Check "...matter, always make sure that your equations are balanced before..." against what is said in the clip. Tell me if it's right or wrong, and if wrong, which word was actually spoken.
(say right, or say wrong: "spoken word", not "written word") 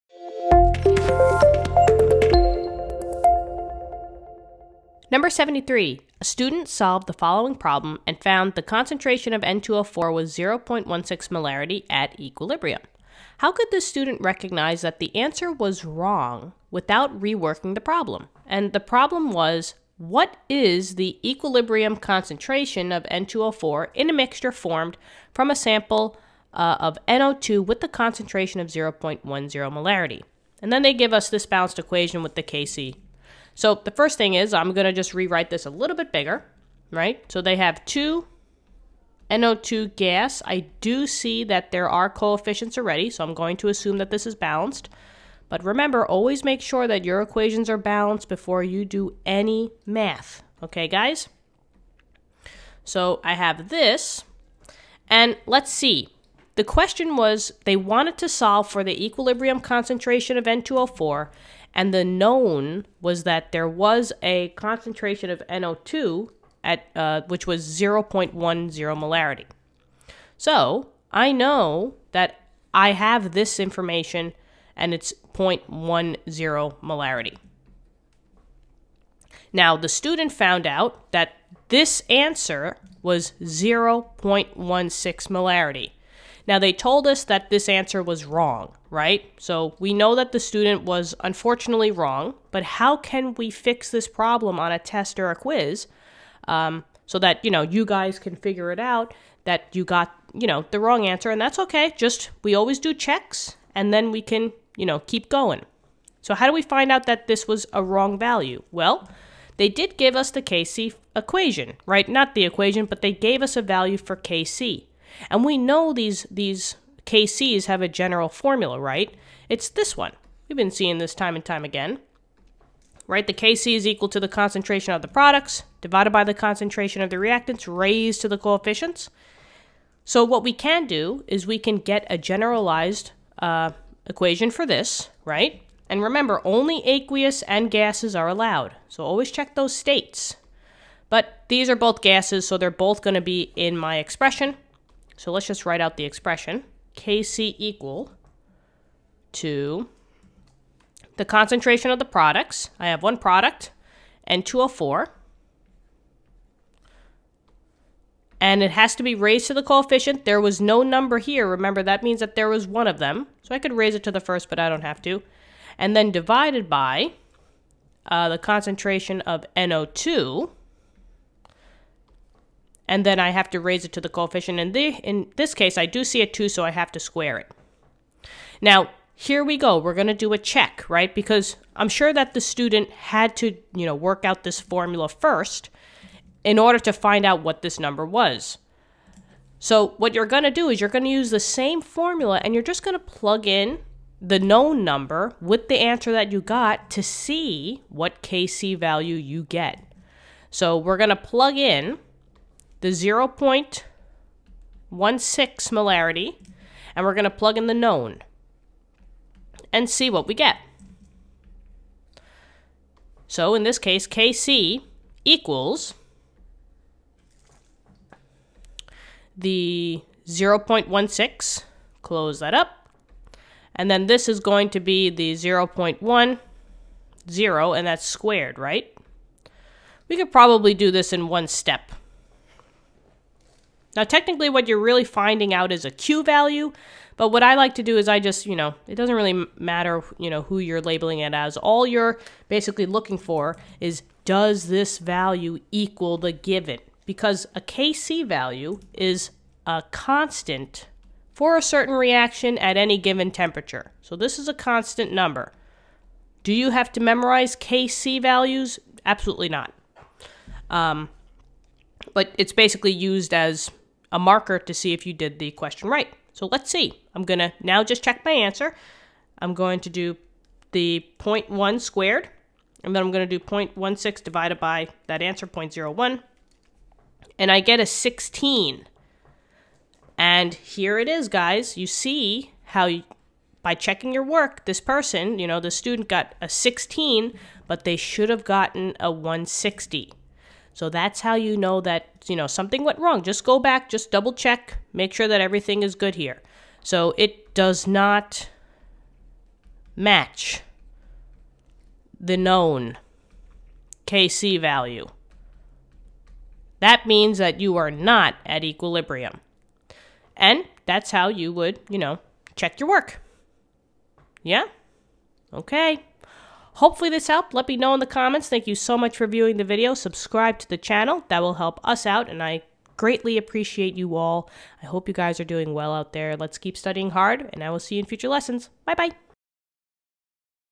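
wrong: "remember", not "matter".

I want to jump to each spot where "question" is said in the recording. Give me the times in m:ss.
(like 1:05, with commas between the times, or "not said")
0:56, 4:25.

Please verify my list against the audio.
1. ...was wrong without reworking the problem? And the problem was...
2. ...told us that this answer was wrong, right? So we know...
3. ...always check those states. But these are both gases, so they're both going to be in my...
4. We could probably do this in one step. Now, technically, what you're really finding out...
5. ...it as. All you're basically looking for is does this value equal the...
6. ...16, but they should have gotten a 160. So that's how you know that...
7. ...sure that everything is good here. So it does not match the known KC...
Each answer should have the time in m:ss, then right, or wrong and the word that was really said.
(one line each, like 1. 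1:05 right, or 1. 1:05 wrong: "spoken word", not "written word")
1. 0:15 right
2. 1:26 right
3. 2:19 right
4. 3:50 right
5. 4:01 right
6. 4:46 right
7. 4:55 right.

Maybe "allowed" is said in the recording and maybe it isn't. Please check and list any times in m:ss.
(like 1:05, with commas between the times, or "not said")
2:18.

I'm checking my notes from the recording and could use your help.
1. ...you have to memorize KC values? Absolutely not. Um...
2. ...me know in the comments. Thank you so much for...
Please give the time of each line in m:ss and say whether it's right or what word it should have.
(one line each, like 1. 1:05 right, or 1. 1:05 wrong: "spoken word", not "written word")
1. 4:16 right
2. 5:17 right.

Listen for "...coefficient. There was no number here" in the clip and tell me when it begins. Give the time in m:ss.
2:39.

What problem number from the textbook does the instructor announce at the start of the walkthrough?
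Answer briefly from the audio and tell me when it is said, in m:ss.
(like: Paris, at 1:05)
73, at 0:05.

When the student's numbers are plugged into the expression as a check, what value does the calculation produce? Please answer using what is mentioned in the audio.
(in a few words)
16.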